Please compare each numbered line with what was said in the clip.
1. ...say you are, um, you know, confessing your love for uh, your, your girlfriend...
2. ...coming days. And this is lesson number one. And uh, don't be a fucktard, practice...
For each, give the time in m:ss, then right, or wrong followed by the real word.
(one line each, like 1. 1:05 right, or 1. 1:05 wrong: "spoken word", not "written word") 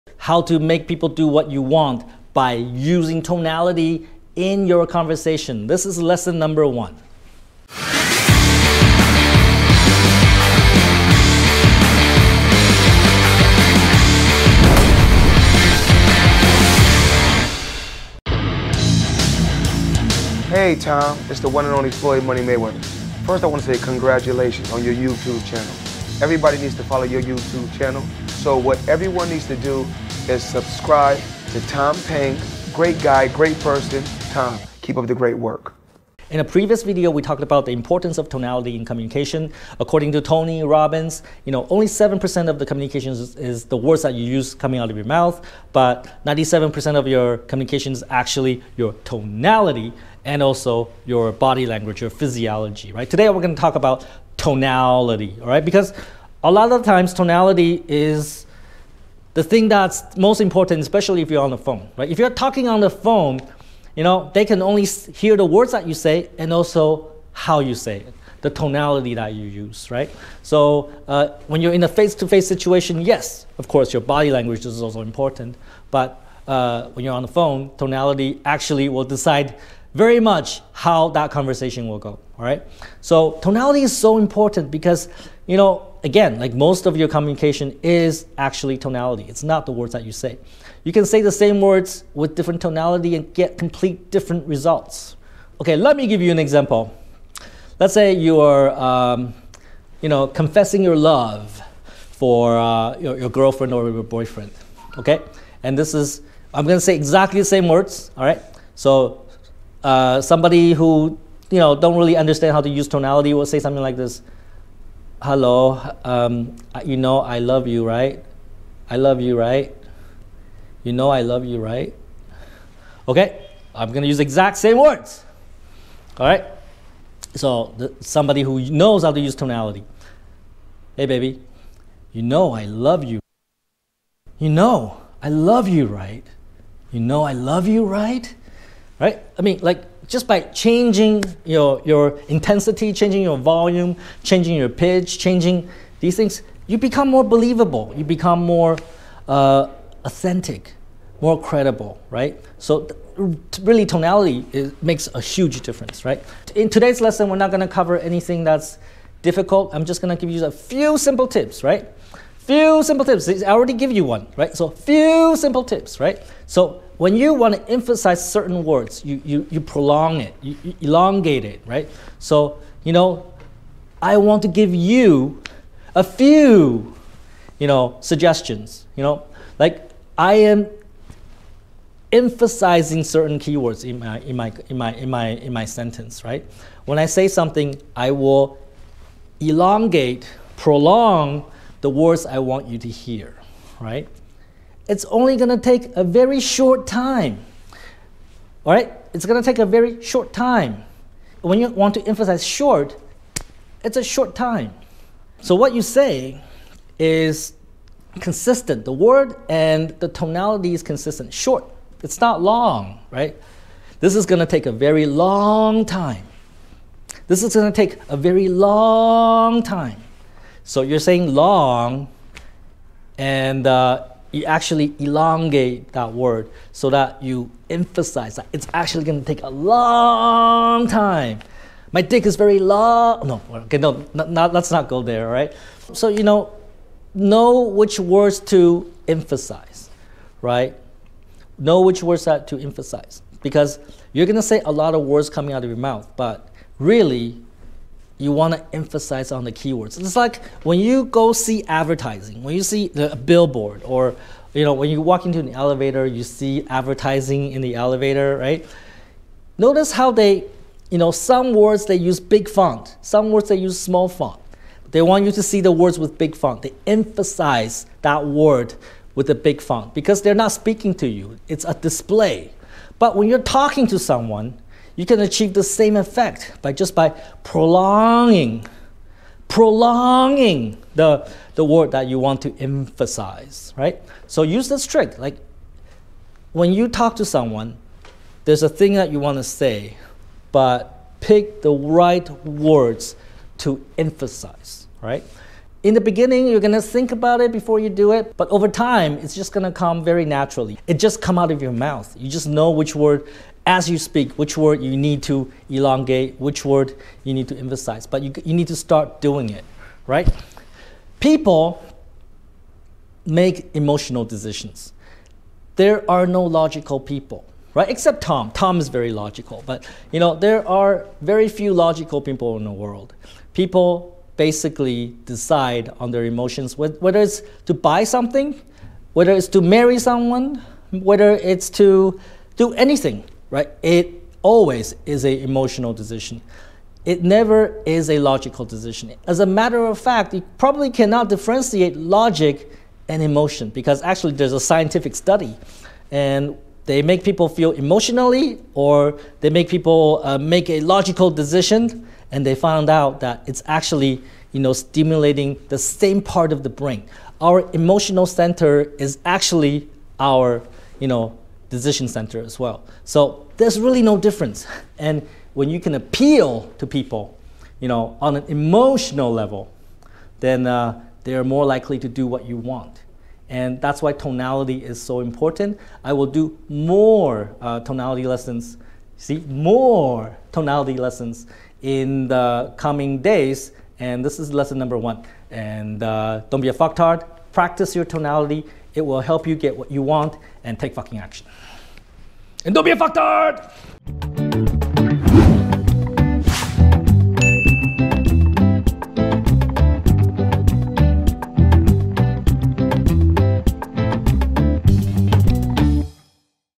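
1. 1:37 right
2. 6:22 right.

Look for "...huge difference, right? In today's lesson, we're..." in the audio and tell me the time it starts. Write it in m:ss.
2:35.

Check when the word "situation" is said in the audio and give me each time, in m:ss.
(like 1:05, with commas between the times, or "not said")
1:12.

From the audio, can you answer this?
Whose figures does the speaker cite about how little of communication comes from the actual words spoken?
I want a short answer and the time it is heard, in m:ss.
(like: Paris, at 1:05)
Tony Robbins, at 0:40.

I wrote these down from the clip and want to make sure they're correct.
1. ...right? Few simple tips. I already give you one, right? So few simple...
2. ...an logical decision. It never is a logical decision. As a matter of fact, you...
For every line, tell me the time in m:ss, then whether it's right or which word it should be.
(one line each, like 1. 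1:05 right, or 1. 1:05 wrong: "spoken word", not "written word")
1. 2:41 right
2. 5:35 wrong: "emotional", not "logical".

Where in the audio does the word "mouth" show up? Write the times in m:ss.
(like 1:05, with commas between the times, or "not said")
0:45, 4:05, 5:01.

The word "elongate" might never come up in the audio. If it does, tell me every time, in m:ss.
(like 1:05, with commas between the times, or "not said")
2:50, 3:09, 3:44, 5:05.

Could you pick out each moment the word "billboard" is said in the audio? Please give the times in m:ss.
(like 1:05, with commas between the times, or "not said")
4:13.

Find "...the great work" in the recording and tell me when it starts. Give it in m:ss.
0:35.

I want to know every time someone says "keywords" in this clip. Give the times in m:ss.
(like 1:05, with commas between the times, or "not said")
3:03, 4:09.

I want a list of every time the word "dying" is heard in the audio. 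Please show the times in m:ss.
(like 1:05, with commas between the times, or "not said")
not said.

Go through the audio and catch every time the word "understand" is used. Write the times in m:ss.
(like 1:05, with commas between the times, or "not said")
1:52.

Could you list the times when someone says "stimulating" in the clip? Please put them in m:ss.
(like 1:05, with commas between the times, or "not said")
5:54.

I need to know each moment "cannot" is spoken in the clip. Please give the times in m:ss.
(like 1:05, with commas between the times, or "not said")
5:40.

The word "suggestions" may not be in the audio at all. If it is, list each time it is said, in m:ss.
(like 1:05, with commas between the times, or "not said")
2:58.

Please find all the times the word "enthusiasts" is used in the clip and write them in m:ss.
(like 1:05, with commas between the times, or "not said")
not said.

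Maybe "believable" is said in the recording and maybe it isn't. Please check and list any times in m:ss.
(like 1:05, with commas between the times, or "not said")
2:27.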